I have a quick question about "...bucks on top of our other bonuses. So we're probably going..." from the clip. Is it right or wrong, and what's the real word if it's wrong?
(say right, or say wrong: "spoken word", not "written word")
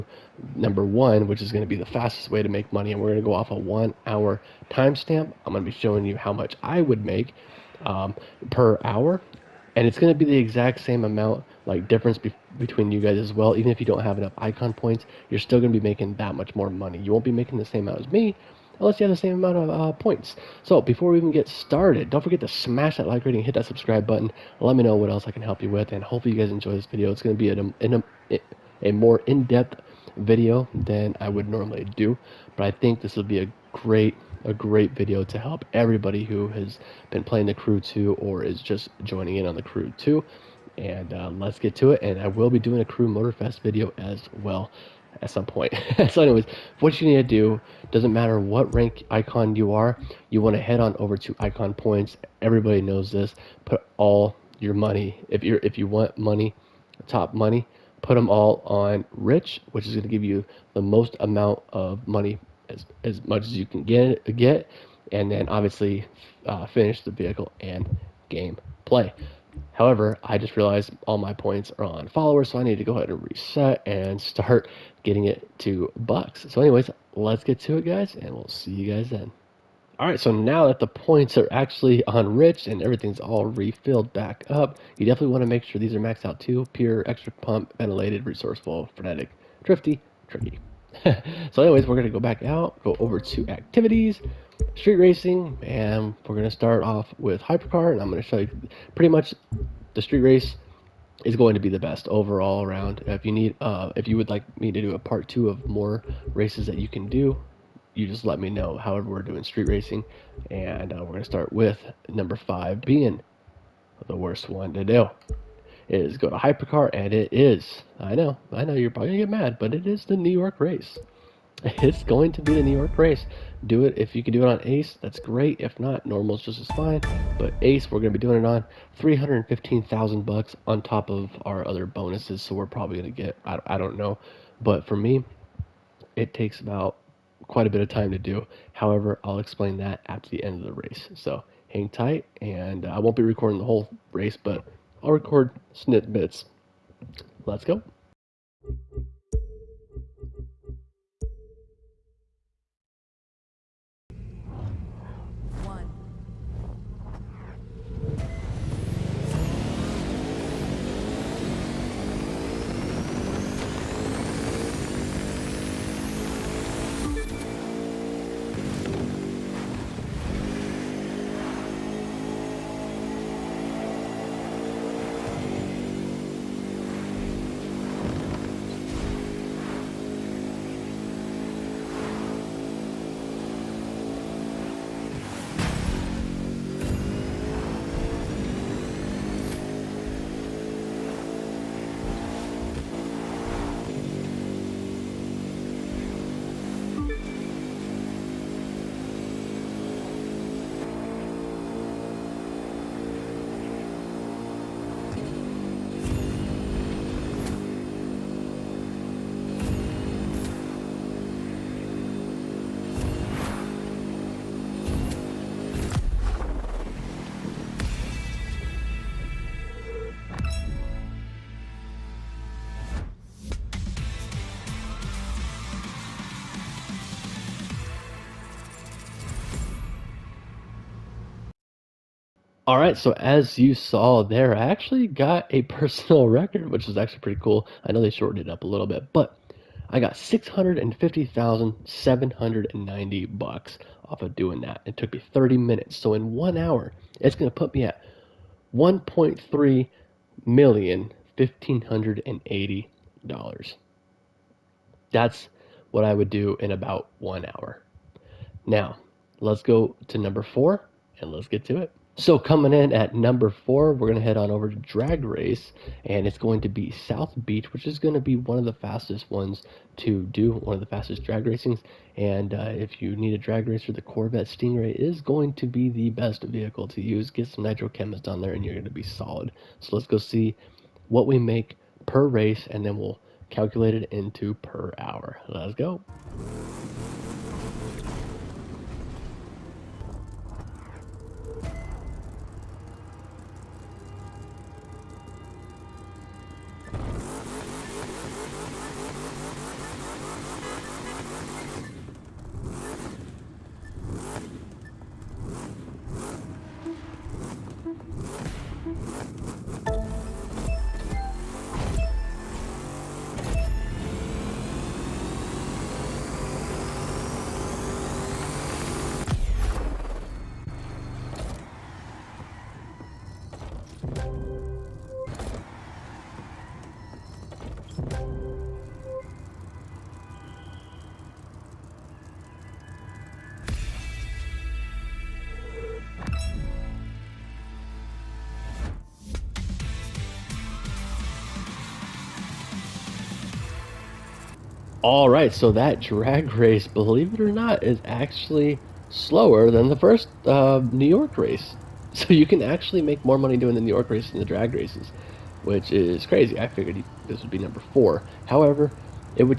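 right.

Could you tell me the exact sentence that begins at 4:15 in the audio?
That's what I would do in about 1 hour.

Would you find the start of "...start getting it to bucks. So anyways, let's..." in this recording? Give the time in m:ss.
1:14.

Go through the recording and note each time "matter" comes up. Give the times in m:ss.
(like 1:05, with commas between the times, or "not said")
0:48.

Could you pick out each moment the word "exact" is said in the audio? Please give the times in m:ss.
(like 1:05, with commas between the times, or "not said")
0:10.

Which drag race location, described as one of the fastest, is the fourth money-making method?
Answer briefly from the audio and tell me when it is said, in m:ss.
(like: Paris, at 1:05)
South Beach, at 4:26.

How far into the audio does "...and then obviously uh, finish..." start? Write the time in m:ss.
1:05.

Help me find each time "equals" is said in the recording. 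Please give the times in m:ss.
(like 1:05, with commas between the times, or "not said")
not said.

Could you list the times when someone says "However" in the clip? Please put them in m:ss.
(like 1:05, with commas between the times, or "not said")
1:09, 1:48, 2:18, 5:58.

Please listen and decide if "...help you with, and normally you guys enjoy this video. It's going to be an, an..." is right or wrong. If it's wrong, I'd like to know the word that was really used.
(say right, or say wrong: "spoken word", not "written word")
wrong: "hopefully", not "normally".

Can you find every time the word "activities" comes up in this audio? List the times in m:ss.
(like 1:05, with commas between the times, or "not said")
1:33.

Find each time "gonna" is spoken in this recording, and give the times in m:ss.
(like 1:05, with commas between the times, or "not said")
4:24, 4:38.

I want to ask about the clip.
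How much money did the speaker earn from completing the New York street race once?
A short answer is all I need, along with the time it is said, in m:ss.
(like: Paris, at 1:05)
650,790 bucks, at 4:00.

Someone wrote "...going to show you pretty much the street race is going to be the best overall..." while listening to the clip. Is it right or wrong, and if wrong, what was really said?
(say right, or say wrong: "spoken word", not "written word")
right.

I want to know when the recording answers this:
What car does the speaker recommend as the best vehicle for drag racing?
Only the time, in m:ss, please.
4:34.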